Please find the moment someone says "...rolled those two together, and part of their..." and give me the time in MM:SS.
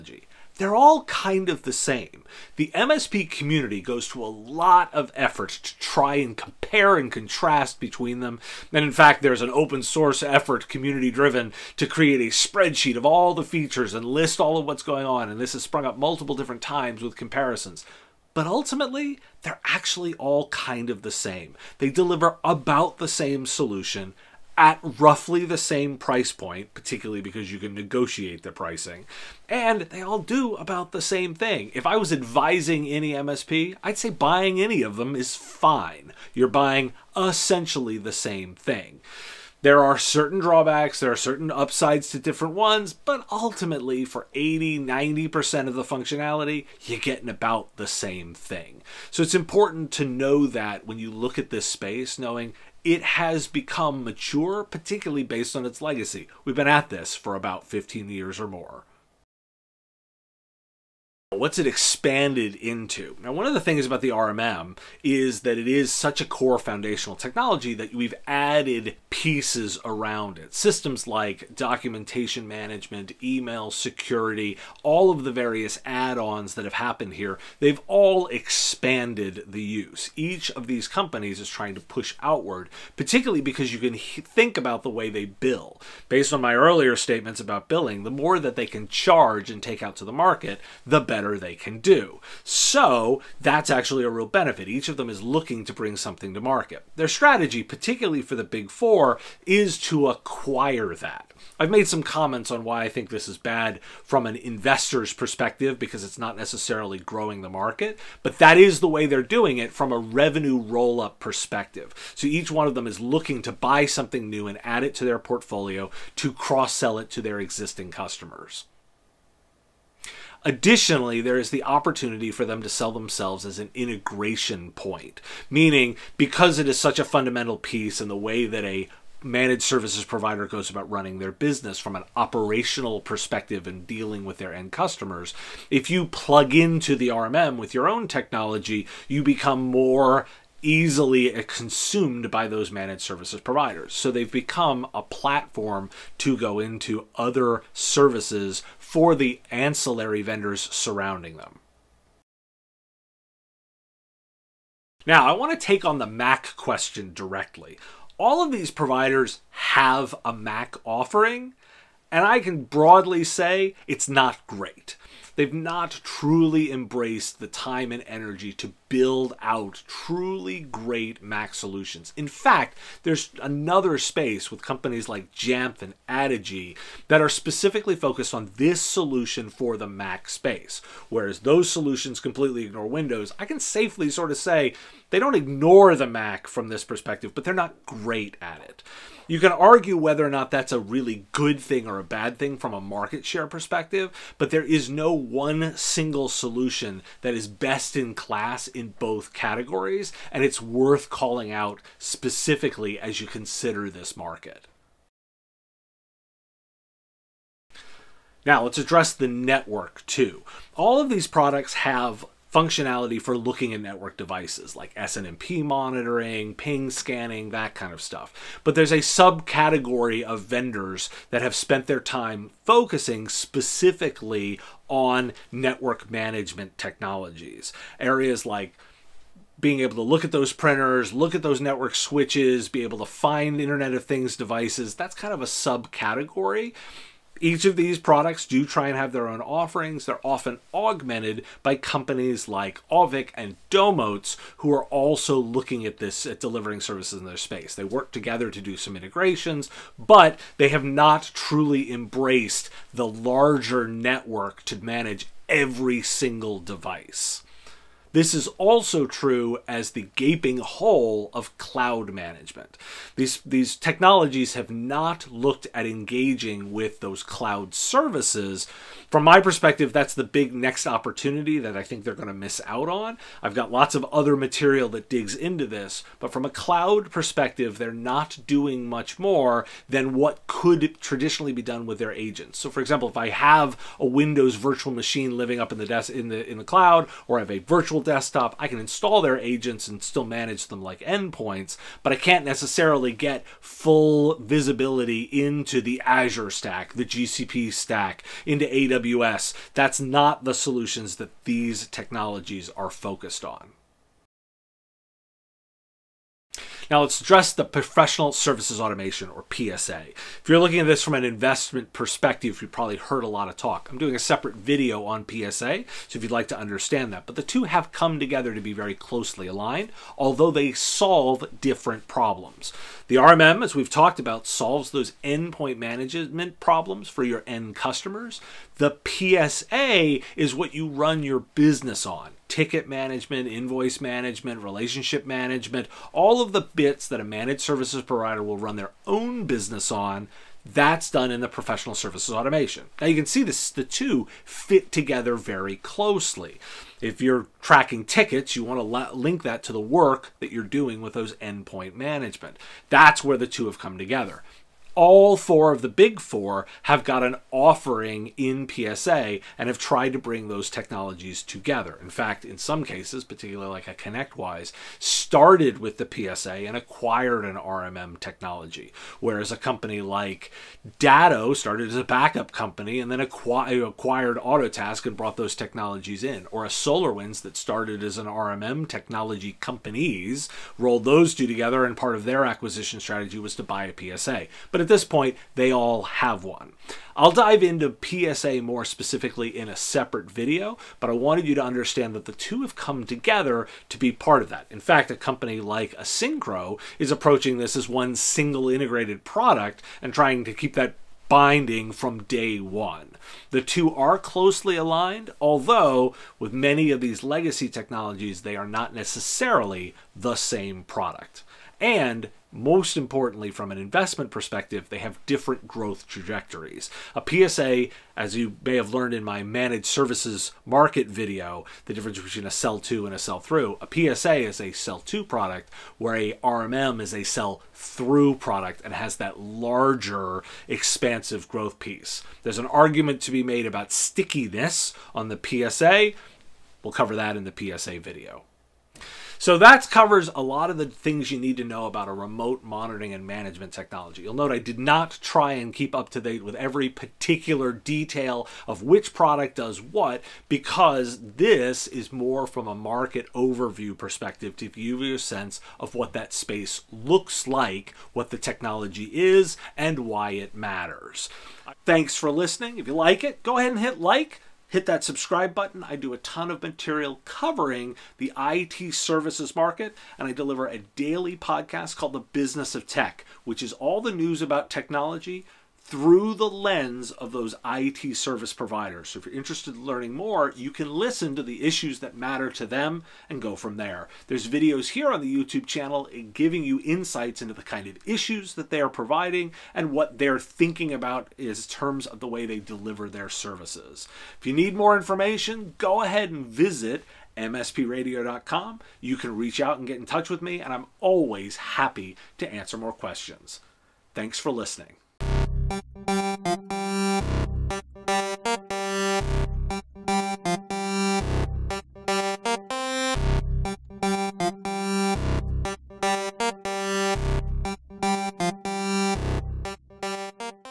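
06:20.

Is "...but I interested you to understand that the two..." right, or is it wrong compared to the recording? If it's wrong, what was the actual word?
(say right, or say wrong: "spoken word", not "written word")
wrong: "wanted", not "interested".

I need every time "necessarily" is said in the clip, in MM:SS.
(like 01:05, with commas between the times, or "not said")
01:46, 04:52, 06:48.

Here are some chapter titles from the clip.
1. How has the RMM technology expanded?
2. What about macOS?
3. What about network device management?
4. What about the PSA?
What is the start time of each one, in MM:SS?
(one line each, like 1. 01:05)
1. 01:00
2. 02:33
3. 03:25
4. 05:04.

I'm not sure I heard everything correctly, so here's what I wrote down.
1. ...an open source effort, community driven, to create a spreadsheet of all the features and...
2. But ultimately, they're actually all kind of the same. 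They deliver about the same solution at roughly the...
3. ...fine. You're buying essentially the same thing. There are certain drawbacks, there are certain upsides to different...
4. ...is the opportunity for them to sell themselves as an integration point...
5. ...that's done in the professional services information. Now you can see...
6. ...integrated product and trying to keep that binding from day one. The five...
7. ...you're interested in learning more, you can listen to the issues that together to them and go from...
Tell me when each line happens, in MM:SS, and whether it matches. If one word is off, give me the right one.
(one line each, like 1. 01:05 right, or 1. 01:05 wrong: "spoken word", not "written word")
1. 00:09 right
2. 00:18 right
3. 00:35 right
4. 02:01 right
5. 05:40 wrong: "automation", not "information"
6. 06:38 wrong: "two", not "five"
7. 07:59 wrong: "matter", not "together".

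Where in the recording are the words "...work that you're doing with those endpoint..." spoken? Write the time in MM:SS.
05:49.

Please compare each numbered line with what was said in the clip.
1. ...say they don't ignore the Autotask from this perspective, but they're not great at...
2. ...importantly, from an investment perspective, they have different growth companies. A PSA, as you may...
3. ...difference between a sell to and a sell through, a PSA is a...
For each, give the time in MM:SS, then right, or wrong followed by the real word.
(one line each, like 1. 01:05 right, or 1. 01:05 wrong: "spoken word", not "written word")
1. 03:04 wrong: "Mac", not "Autotask"
2. 06:52 wrong: "trajectories", not "companies"
3. 07:01 right.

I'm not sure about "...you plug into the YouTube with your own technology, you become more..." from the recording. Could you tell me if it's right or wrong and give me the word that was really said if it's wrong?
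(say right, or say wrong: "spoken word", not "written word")
wrong: "RMM", not "YouTube".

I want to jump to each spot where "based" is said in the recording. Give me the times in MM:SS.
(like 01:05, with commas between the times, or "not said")
00:55, 01:26.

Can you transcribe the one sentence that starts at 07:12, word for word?
There's an argument to be made about stickiness on the PSA.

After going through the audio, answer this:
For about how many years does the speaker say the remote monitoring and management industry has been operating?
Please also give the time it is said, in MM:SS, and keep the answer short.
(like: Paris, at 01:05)
15 years, at 00:57.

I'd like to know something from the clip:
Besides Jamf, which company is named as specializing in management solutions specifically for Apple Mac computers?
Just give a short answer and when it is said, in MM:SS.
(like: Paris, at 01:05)
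Addigy, at 02:56.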